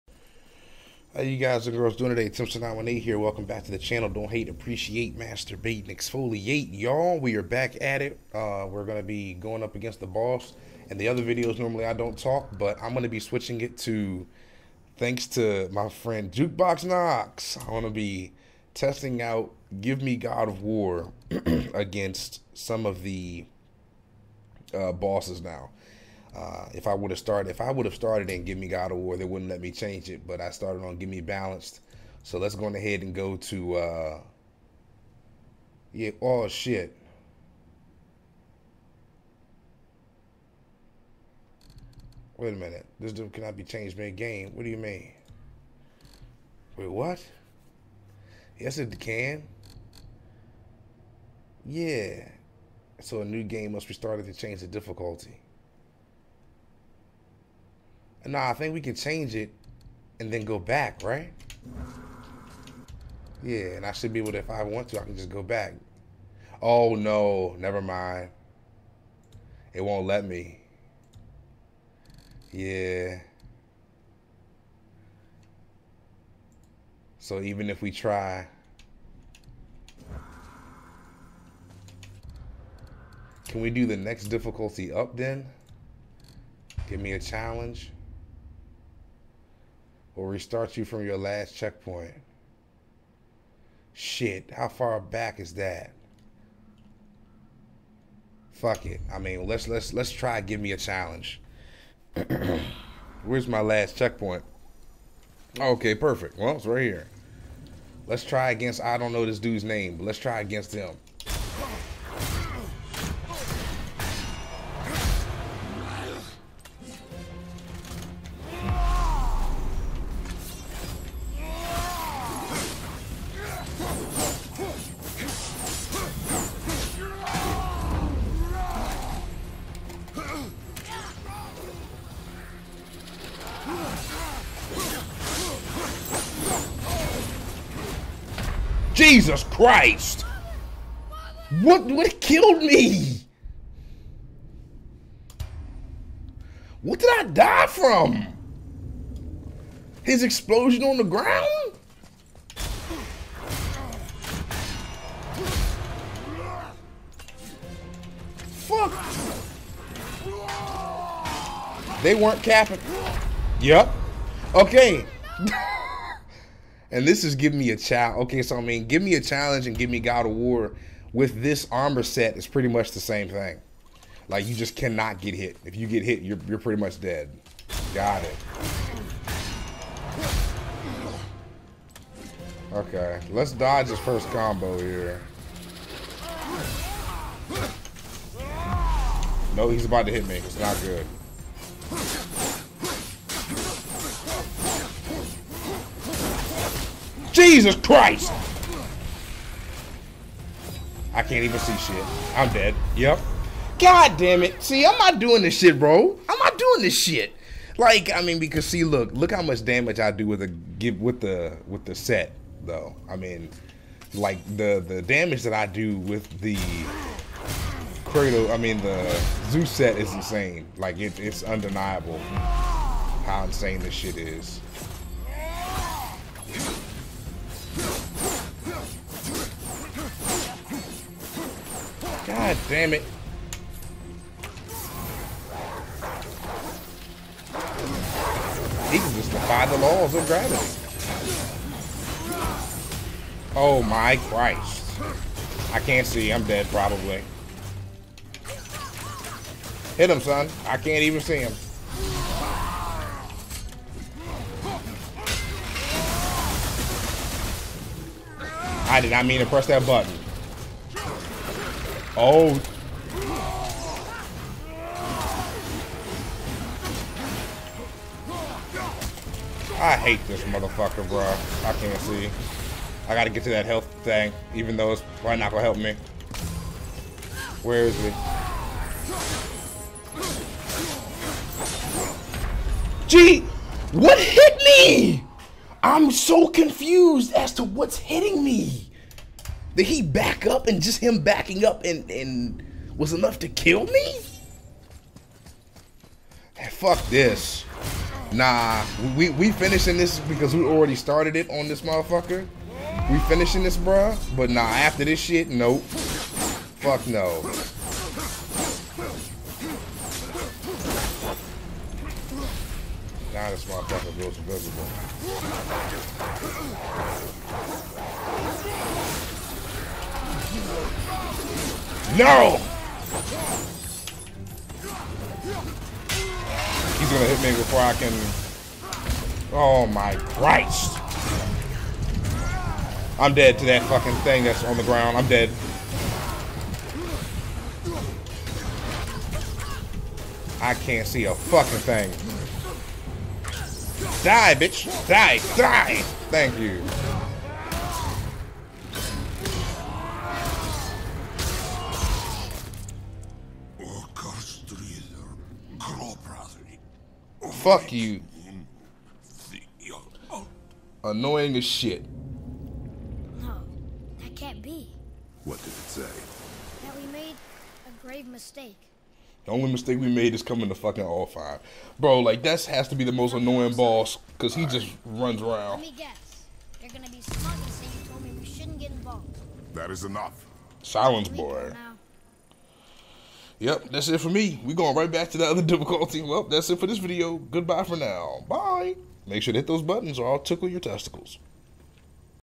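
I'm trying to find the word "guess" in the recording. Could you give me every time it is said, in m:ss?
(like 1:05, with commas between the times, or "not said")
6:15.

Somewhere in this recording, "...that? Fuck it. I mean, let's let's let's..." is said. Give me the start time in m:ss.
1:35.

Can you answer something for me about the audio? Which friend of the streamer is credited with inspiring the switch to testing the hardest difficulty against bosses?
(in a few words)
Jukebox Knox.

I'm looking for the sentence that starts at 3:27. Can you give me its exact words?
Like, I mean, because see, look, look how much damage I do with the with the with the set, though.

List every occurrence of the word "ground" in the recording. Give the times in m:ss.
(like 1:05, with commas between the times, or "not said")
2:31, 5:34.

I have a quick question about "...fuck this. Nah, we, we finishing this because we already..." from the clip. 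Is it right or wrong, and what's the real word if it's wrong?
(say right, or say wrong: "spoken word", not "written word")
right.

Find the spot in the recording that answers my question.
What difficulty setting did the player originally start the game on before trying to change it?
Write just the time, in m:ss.
0:30.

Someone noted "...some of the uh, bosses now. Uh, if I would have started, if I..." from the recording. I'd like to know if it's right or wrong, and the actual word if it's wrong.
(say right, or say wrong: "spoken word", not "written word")
right.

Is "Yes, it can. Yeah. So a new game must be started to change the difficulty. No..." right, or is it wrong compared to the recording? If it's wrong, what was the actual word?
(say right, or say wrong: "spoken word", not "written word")
right.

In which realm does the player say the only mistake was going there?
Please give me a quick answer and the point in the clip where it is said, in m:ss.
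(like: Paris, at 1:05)
Alfheim, at 6:11.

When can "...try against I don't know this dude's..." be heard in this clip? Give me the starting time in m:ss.
1:48.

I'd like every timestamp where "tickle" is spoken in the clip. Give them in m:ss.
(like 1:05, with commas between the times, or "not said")
6:30.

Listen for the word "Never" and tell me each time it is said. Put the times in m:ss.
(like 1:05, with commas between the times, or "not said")
1:07.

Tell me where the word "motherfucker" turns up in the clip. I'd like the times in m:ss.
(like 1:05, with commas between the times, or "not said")
4:30, 5:01, 5:13.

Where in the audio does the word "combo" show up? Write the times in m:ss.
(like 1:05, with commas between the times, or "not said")
3:04.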